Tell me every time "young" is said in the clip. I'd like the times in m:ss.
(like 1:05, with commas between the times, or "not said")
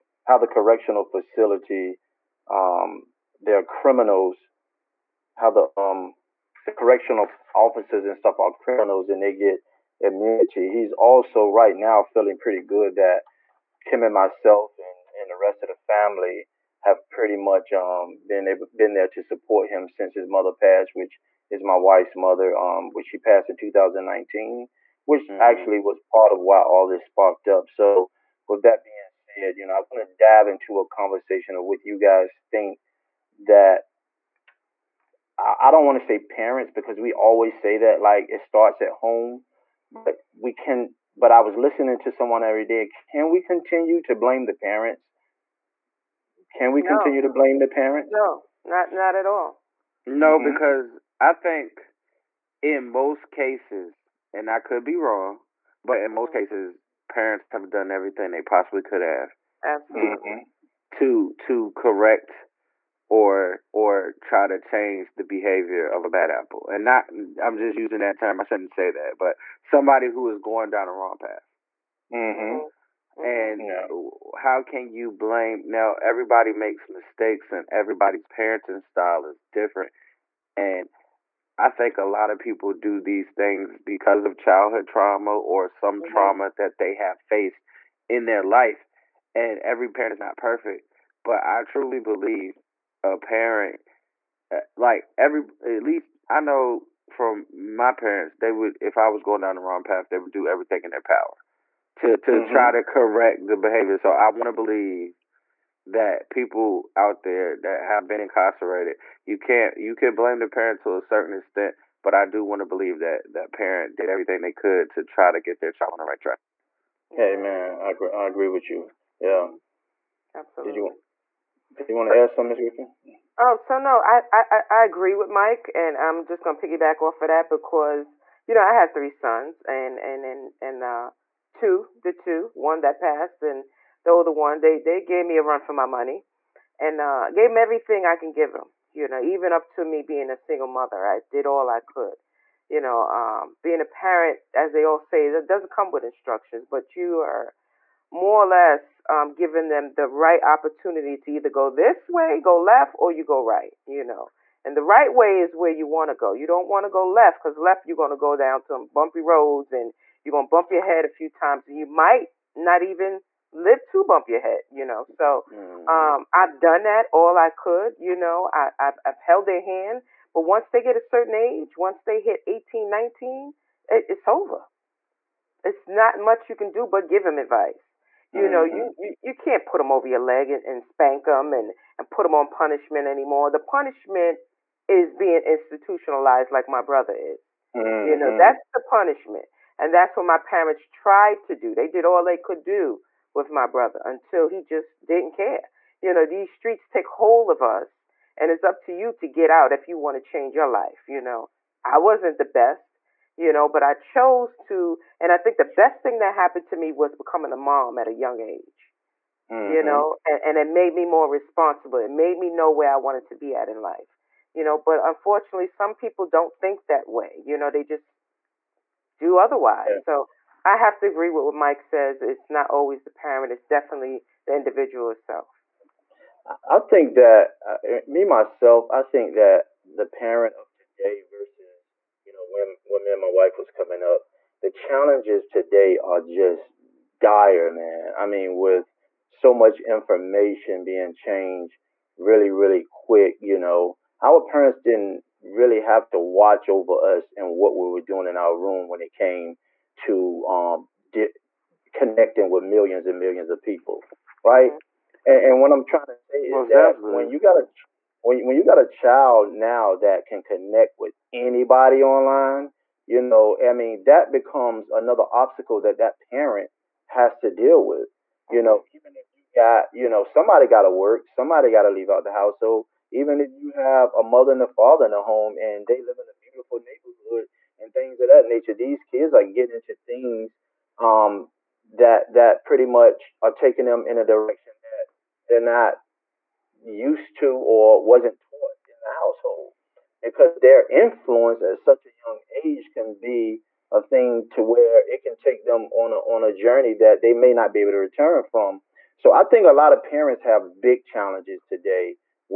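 3:28, 4:52.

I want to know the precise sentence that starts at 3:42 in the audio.
It's not always the parent, it's definitely the individual itself.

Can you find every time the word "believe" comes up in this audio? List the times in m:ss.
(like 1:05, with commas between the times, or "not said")
1:31, 1:44, 1:52.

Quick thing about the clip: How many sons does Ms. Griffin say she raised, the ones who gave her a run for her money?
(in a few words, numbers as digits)
3.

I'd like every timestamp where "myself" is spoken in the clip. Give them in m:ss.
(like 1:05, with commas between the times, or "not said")
0:14, 3:48.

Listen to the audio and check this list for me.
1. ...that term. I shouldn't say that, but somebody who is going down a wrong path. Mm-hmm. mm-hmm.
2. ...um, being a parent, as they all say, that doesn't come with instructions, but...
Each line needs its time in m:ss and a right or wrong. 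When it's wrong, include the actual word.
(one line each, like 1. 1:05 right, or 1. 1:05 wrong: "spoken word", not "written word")
1. 1:07 right
2. 2:23 right.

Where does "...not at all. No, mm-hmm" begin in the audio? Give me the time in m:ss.
0:48.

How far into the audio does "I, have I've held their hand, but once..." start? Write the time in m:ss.
2:48.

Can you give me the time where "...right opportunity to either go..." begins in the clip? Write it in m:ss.
2:30.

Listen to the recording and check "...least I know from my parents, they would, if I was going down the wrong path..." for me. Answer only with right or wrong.
right.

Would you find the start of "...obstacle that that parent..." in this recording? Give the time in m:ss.
4:25.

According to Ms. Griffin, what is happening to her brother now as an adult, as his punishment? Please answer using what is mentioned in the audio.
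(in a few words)
being institutionalized.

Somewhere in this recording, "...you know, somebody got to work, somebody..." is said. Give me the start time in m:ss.
4:29.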